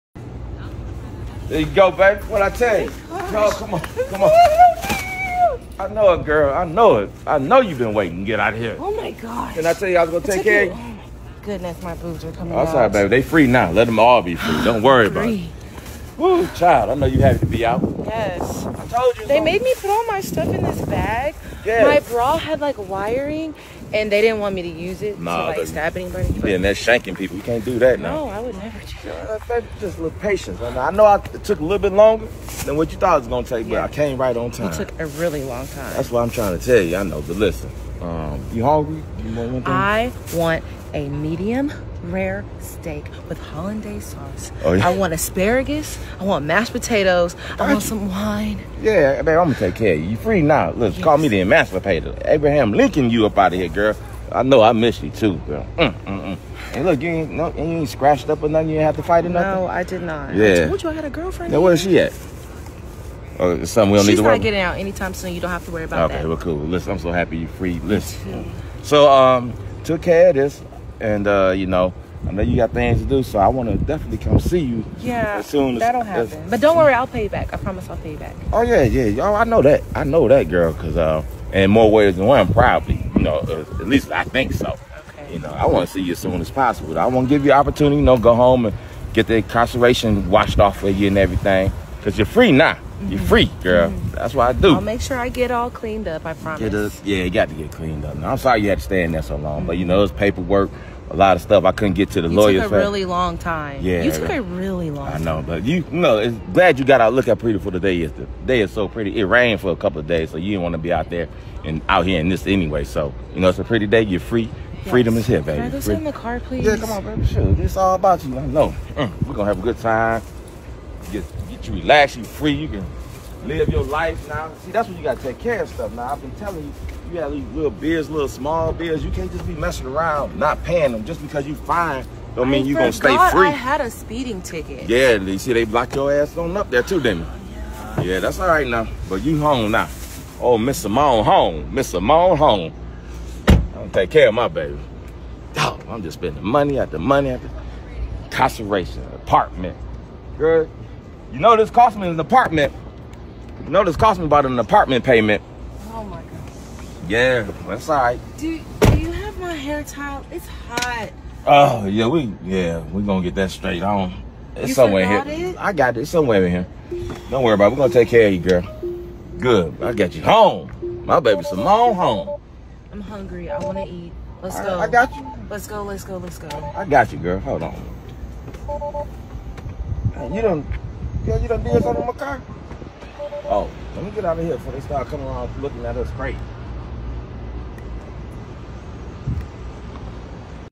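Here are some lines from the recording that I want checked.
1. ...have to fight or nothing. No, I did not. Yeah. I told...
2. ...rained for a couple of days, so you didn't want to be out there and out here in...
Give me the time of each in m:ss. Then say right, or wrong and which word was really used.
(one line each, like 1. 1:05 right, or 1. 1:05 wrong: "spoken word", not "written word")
1. 0:58 right
2. 1:49 right.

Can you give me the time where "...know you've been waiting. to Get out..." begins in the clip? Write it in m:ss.
0:07.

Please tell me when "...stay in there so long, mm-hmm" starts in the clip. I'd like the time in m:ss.
1:38.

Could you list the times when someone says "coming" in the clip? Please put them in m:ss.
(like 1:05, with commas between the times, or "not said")
0:12, 3:05.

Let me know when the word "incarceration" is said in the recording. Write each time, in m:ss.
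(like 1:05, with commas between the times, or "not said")
1:29, 2:28.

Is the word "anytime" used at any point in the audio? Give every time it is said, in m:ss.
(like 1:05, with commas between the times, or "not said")
1:04.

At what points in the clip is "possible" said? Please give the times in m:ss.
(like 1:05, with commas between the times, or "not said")
1:26.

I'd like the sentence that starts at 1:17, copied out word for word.
I promise I'll pay you back.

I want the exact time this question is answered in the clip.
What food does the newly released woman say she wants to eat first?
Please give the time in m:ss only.
0:41.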